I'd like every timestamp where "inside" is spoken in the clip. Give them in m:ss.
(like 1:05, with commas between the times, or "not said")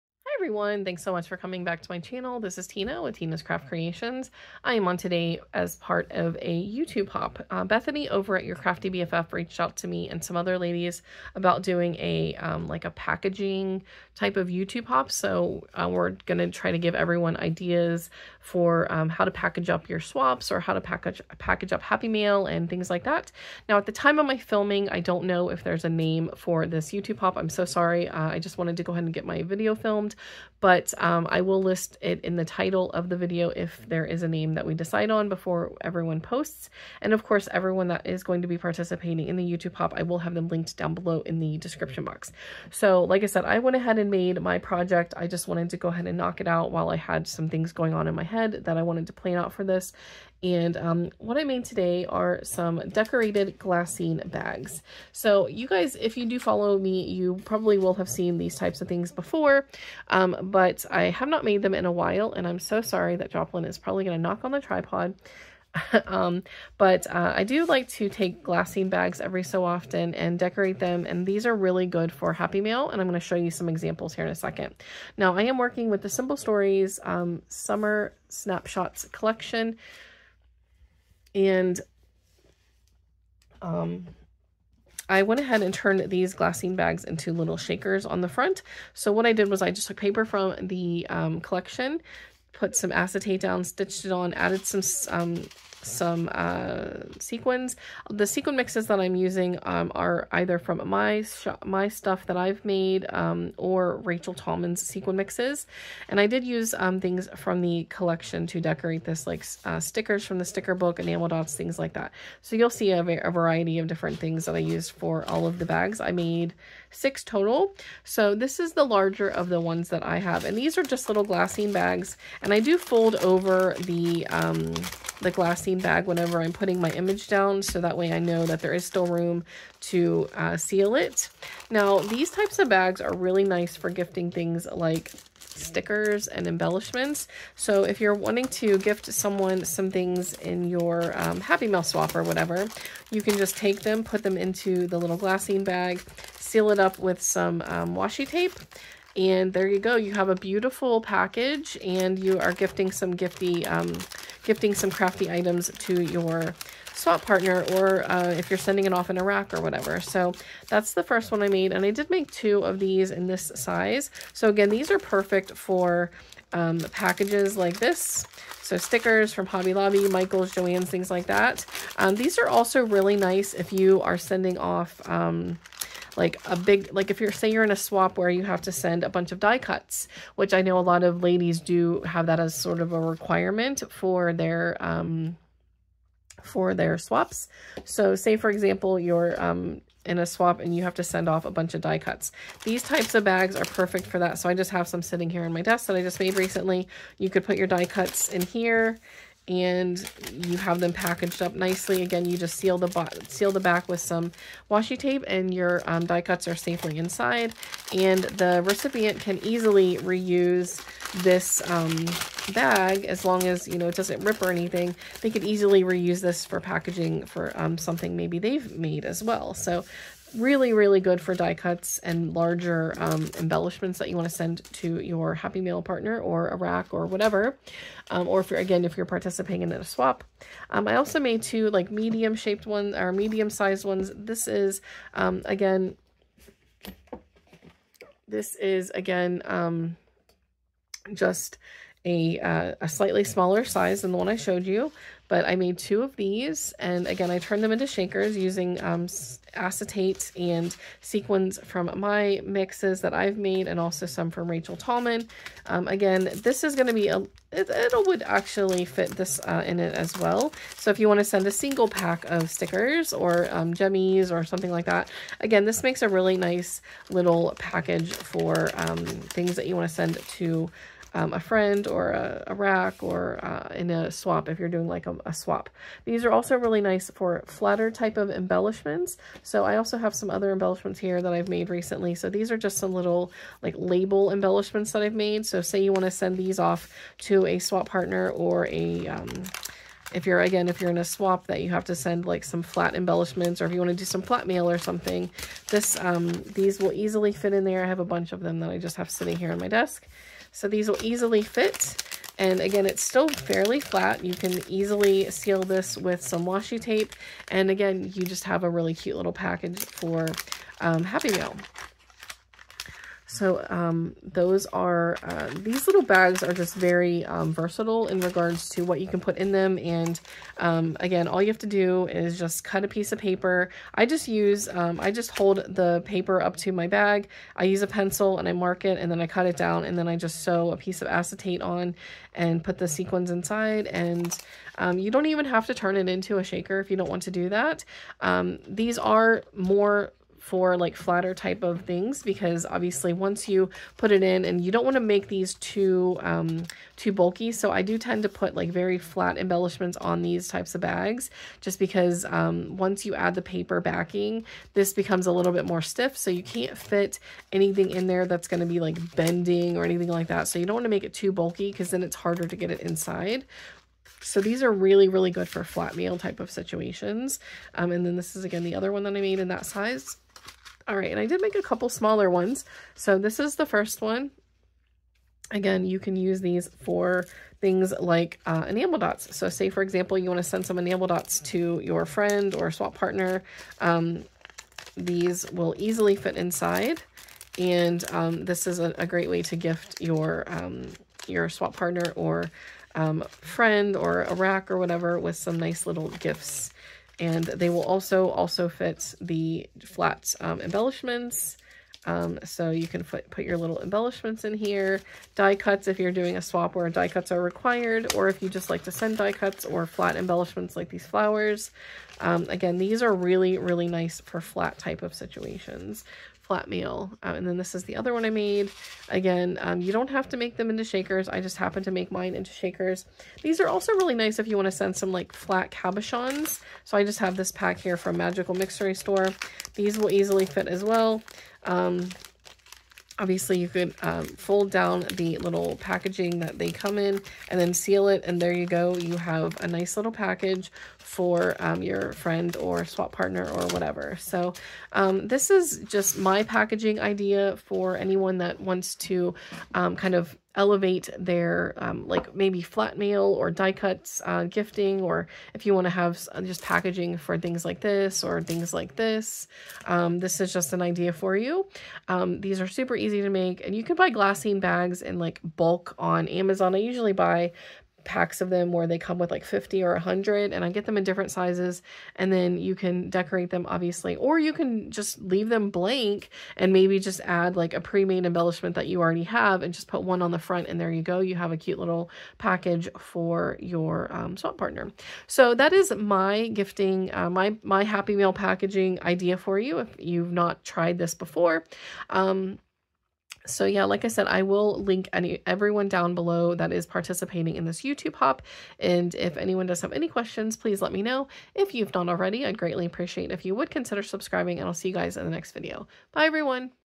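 3:26, 5:33, 6:02, 6:26.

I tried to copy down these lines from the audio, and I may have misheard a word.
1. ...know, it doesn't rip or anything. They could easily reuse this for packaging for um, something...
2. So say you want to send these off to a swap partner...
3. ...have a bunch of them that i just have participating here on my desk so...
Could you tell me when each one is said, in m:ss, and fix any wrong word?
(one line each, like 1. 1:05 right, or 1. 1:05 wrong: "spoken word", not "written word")
1. 3:33 right
2. 4:45 right
3. 4:57 wrong: "sitting", not "participating".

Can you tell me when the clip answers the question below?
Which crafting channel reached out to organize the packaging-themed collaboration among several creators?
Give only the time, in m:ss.
0:08.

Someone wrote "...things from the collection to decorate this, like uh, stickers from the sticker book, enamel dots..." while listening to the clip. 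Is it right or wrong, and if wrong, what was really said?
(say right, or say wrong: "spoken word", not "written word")
right.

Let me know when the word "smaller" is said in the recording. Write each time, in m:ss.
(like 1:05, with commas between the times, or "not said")
4:03, 6:11.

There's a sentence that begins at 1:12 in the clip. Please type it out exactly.
And I'm going to show you some examples here in a second.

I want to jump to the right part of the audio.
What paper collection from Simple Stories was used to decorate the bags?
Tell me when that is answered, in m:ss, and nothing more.
1:17.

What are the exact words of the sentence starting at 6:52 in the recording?
Um, again, these are really, really nice for flat type of situations flat mail.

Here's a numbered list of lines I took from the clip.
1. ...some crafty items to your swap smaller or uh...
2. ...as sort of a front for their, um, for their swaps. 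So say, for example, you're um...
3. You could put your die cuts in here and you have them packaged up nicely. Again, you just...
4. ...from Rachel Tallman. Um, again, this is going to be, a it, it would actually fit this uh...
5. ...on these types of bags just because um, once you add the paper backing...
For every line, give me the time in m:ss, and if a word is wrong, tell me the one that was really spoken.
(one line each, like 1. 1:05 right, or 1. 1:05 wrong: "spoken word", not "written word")
1. 2:34 wrong: "partner", not "smaller"
2. 3:02 wrong: "requirement", not "front"
3. 3:17 right
4. 4:14 right
5. 5:49 right.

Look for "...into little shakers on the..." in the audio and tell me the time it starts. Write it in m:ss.
1:27.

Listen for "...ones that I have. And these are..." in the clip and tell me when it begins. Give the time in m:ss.
1:59.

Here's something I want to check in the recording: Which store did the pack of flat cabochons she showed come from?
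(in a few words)
Magical Mixery Store.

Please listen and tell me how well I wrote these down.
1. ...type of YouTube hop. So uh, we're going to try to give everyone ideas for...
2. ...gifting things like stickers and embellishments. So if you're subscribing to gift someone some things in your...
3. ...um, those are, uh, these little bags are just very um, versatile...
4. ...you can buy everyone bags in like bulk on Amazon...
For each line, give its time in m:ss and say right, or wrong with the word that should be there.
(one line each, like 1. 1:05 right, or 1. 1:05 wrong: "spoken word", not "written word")
1. 0:14 right
2. 2:13 wrong: "wanting", not "subscribing"
3. 5:13 right
4. 7:43 wrong: "glassine", not "everyone".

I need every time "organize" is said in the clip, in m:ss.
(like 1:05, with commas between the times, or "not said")
not said.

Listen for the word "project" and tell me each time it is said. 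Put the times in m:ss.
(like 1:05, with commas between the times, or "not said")
0:44.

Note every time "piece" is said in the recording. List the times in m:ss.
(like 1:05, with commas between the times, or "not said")
5:22, 5:30.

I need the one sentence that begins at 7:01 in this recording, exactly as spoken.
I just happen to make mine into shakers.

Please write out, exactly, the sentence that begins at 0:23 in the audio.
Now at the time of my filming, I don't know if there's a name for this YouTube hop.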